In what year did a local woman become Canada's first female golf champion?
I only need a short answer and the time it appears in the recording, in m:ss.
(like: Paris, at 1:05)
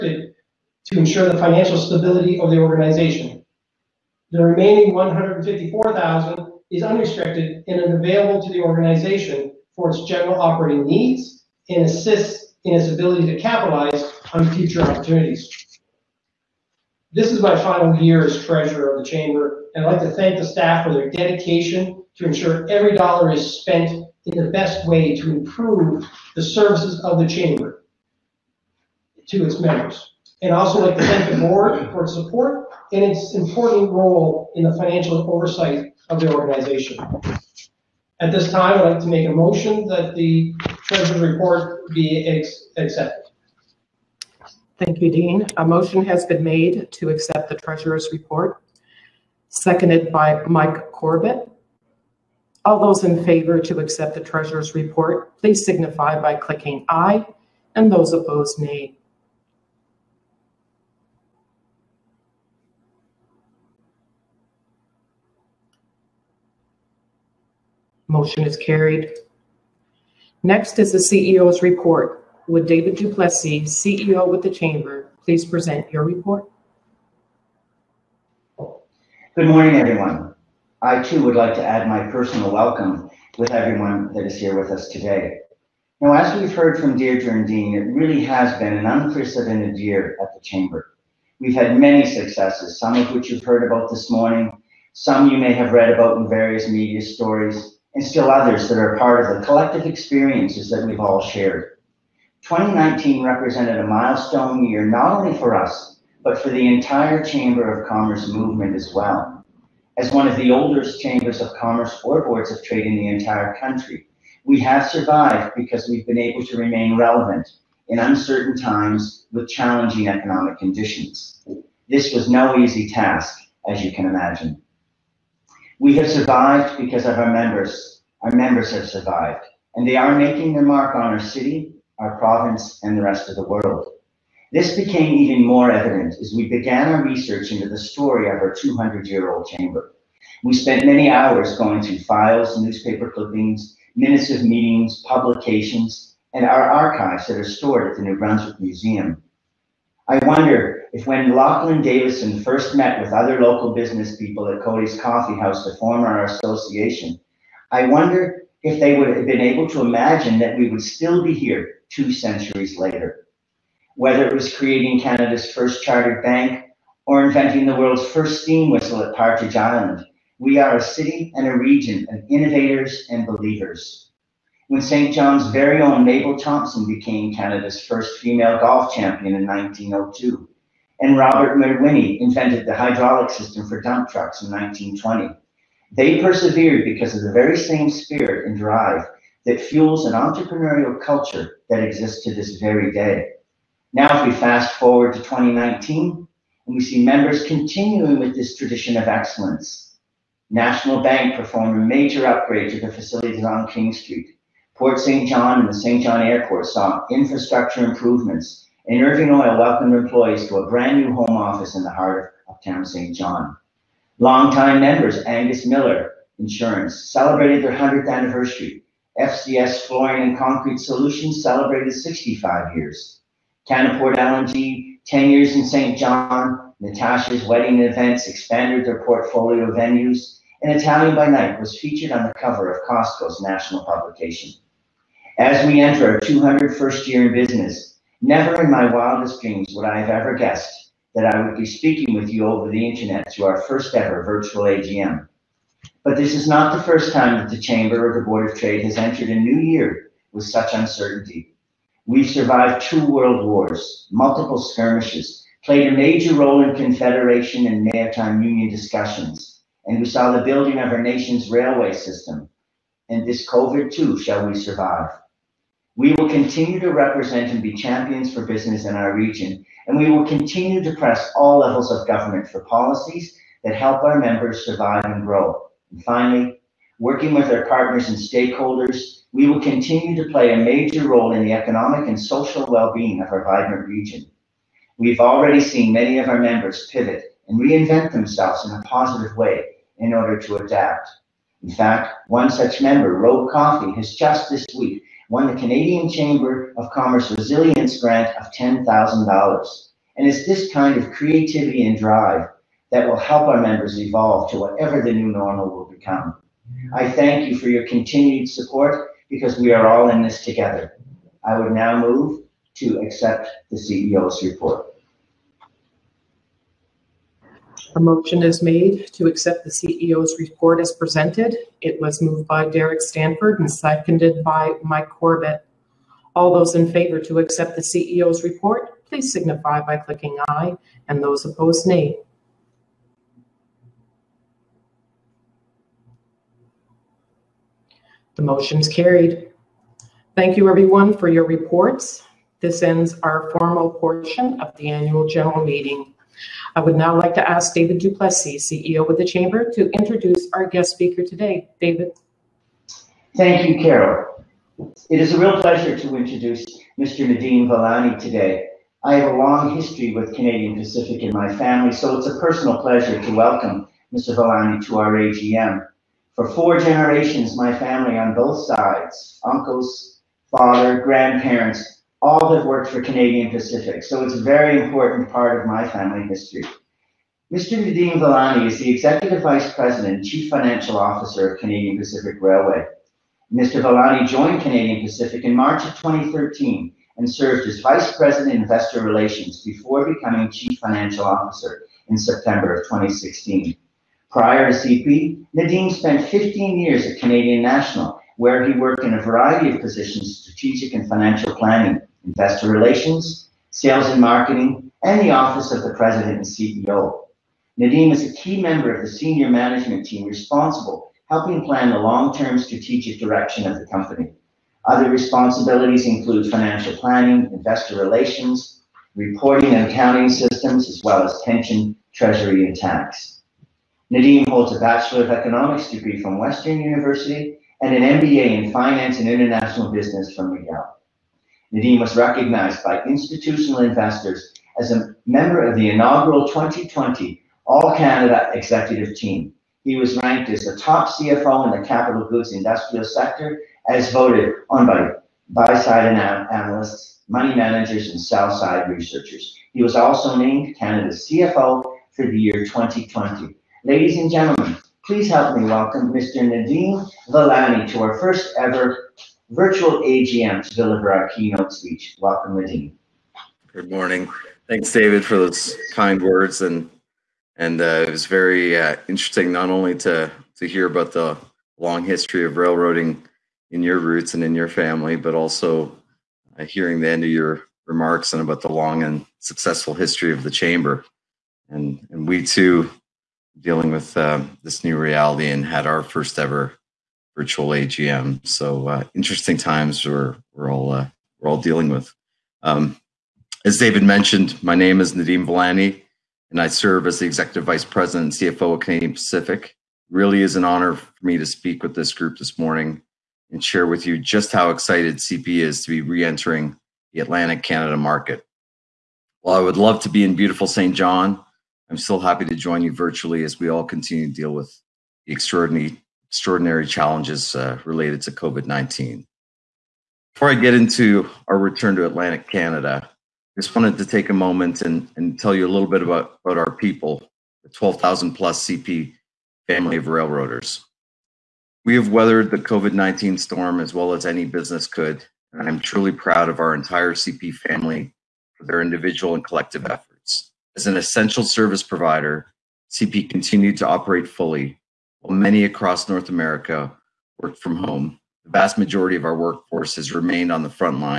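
1902, at 2:59.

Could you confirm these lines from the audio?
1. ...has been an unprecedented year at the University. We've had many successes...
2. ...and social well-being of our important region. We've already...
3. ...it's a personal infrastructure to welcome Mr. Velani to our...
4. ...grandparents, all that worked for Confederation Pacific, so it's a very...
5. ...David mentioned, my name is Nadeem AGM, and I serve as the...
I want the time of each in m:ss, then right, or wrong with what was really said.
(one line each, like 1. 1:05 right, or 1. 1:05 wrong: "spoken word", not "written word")
1. 1:28 wrong: "Chamber", not "University"
2. 4:42 wrong: "vibrant", not "important"
3. 6:02 wrong: "pleasure", not "infrastructure"
4. 6:11 wrong: "Canadian", not "Confederation"
5. 8:13 wrong: "Velani", not "AGM".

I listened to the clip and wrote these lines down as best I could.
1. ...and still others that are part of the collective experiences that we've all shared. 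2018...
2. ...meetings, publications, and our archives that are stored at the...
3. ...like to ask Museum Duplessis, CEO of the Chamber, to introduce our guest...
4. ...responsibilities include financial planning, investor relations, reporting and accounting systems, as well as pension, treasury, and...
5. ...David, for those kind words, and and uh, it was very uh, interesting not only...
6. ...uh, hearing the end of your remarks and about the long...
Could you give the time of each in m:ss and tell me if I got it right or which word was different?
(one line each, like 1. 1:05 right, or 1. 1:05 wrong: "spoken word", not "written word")
1. 1:37 wrong: "2019", not "2018"
2. 2:24 right
3. 5:47 wrong: "David", not "Museum"
4. 6:55 right
5. 7:44 right
6. 7:56 right.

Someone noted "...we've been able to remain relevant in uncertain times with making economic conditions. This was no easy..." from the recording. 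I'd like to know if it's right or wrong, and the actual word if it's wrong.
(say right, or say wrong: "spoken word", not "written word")
wrong: "challenging", not "making".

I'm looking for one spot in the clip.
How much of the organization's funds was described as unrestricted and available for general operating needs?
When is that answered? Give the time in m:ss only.
0:04.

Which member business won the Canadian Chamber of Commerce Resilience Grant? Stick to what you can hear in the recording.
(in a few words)
Rogue Coffee.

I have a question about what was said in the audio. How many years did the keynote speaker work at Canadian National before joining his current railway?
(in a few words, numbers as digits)
15.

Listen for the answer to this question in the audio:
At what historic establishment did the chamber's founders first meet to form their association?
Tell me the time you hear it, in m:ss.
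2:34.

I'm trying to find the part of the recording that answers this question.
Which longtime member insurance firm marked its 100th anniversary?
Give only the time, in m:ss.
3:35.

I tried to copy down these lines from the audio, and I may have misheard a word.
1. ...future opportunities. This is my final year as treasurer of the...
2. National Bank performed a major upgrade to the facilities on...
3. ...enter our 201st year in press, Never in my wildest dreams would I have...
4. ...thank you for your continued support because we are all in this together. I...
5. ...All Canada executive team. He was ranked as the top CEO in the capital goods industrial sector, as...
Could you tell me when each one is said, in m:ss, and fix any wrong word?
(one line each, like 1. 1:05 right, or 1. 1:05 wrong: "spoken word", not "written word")
1. 0:14 right
2. 3:20 right
3. 3:55 wrong: "business", not "press"
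4. 5:07 right
5. 7:17 wrong: "CFO", not "CEO".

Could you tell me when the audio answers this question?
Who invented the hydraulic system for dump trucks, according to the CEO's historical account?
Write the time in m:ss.
3:01.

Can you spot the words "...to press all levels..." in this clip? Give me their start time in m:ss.
4:30.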